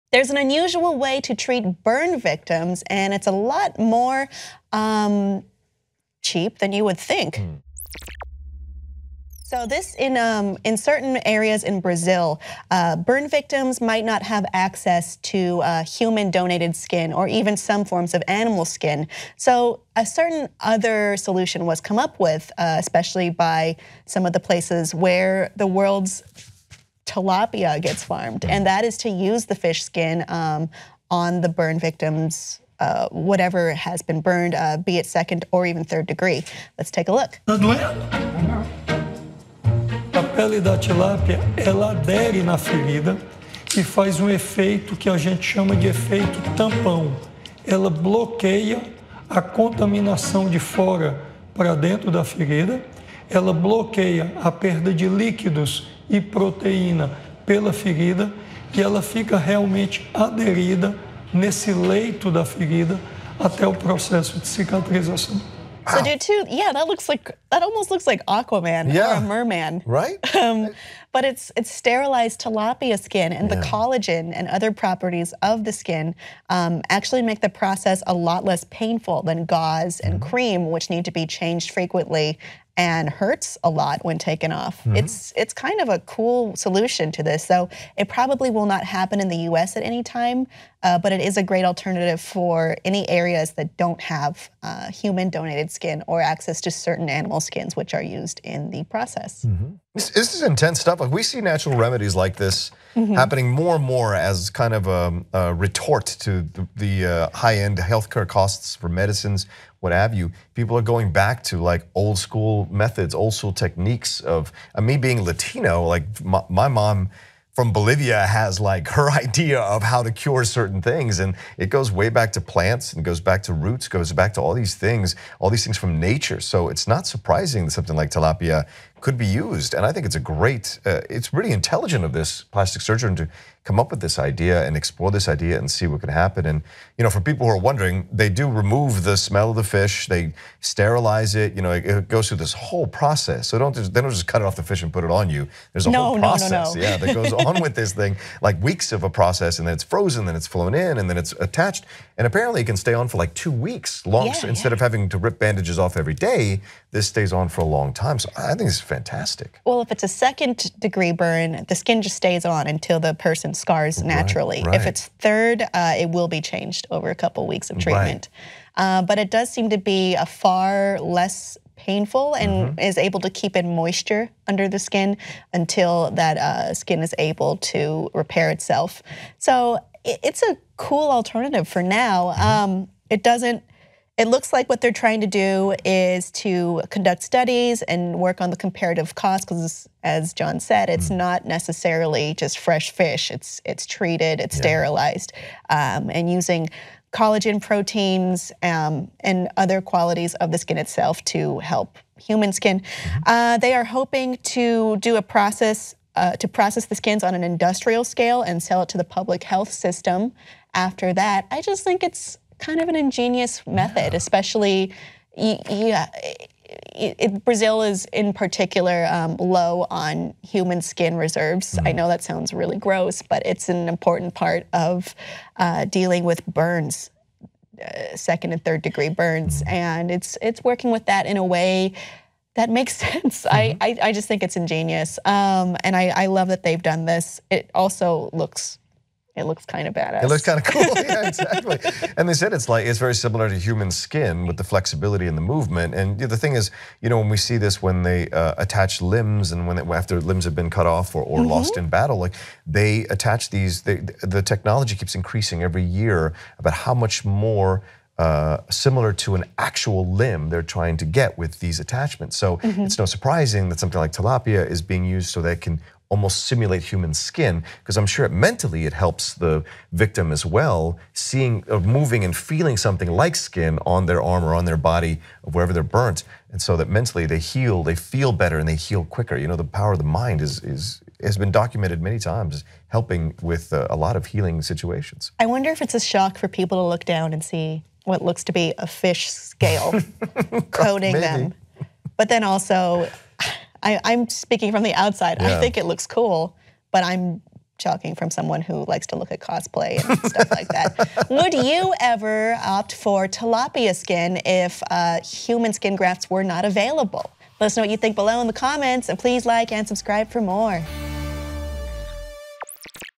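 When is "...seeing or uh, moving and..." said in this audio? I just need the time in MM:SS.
04:31.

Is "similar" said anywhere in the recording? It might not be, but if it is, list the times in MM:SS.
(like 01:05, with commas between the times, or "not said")
04:03, 04:18.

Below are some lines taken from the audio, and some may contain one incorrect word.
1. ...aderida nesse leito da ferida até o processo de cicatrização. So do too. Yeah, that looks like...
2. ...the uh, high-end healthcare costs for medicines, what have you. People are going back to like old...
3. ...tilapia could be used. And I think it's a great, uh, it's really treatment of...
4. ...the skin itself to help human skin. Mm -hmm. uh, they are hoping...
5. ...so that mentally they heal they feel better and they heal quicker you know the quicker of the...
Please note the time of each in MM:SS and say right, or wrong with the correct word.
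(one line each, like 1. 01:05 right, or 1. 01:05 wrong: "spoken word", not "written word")
1. 01:00 right
2. 01:46 right
3. 02:08 wrong: "intelligent", not "treatment"
4. 03:20 right
5. 04:36 wrong: "power", not "quicker".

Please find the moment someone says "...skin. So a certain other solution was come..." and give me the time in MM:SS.
00:18.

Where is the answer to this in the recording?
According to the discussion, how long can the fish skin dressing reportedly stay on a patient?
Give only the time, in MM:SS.
02:33.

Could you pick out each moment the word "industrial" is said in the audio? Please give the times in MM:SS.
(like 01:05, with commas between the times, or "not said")
03:27.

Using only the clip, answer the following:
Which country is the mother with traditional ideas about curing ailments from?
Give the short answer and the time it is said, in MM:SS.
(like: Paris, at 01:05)
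Bolivia, at 01:57.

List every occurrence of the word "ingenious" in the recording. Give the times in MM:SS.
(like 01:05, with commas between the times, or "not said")
03:32, 03:54.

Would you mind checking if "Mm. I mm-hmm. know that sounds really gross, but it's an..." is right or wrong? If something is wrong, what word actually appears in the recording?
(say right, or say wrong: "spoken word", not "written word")
right.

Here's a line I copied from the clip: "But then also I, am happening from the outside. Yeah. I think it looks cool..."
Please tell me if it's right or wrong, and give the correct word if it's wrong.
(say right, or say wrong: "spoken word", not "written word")
wrong: "speaking", not "happening".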